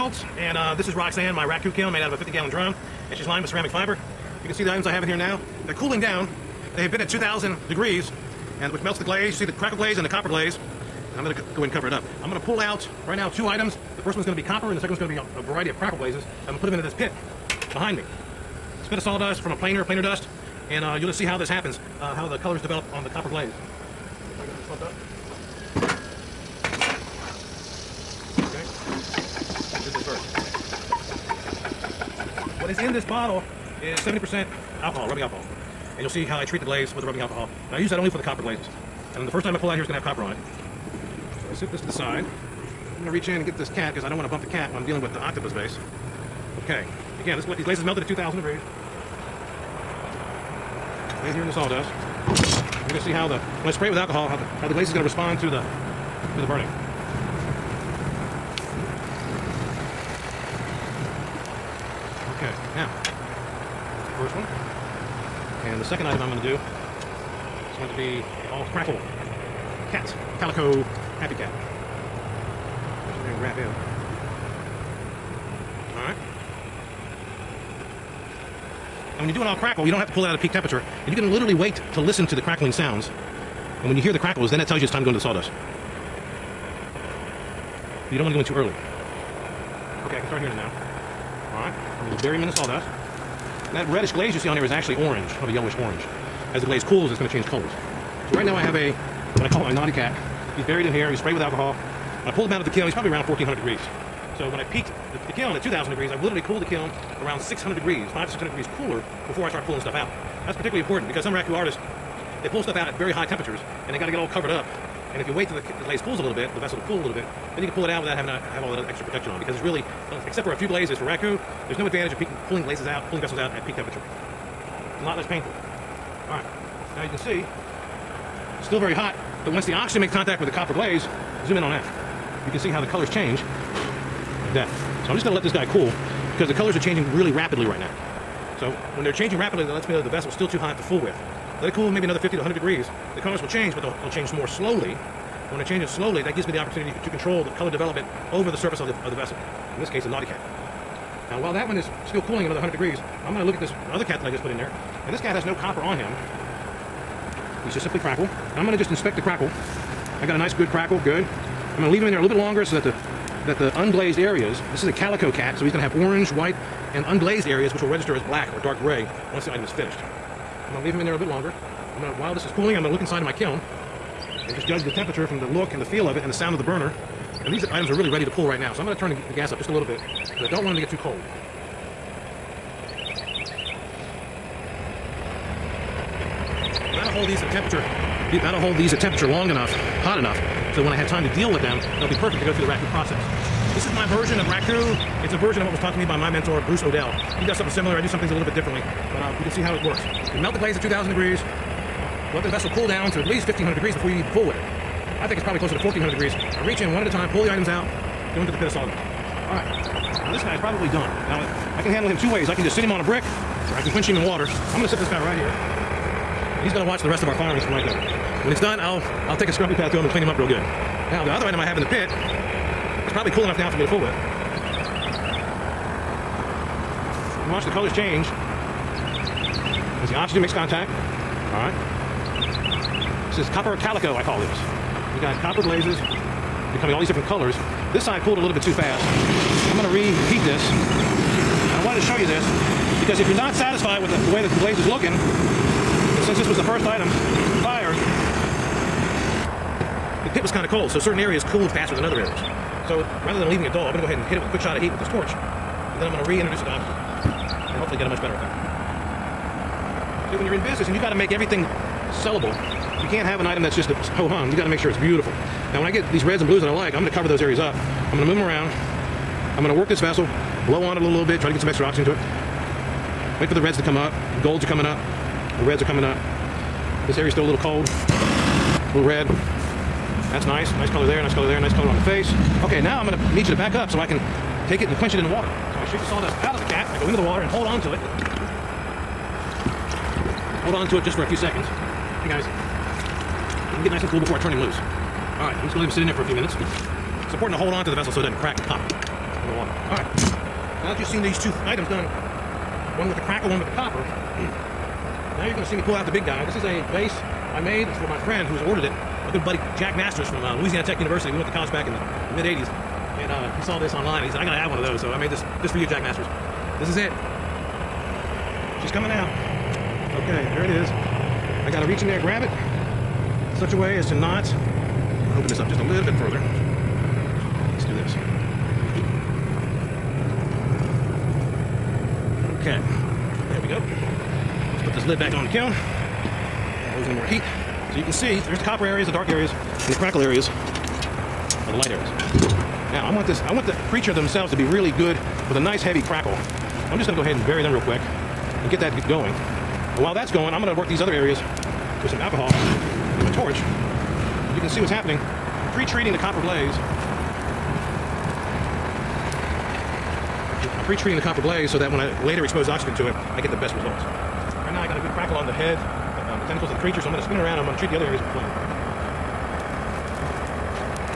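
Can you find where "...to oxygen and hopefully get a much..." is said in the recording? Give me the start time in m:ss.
4:16.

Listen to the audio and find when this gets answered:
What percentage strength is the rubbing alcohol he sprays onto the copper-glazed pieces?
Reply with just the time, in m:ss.
0:33.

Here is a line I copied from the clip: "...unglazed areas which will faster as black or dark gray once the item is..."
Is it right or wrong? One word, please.
wrong.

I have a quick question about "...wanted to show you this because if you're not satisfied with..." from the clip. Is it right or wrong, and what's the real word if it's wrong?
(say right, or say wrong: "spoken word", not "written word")
right.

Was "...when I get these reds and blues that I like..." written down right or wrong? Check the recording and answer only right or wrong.
right.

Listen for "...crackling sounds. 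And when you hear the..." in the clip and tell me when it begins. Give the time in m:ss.
1:22.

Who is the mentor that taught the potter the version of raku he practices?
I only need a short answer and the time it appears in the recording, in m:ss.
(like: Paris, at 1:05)
Bruce Odell, at 3:16.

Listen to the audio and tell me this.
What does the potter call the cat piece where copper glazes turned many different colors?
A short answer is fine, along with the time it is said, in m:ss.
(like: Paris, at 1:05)
copper calico, at 3:53.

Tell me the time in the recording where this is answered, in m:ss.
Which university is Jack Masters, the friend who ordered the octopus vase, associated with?
5:10.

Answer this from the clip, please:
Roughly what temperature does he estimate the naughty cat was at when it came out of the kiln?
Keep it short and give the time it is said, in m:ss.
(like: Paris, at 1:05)
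1400 degrees, at 1:43.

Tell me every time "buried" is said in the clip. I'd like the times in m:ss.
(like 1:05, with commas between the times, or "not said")
1:40.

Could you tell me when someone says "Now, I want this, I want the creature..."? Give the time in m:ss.
5:42.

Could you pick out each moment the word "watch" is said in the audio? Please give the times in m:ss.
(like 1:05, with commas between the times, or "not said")
3:36, 3:47.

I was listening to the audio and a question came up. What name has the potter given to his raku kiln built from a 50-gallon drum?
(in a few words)
Roxanne.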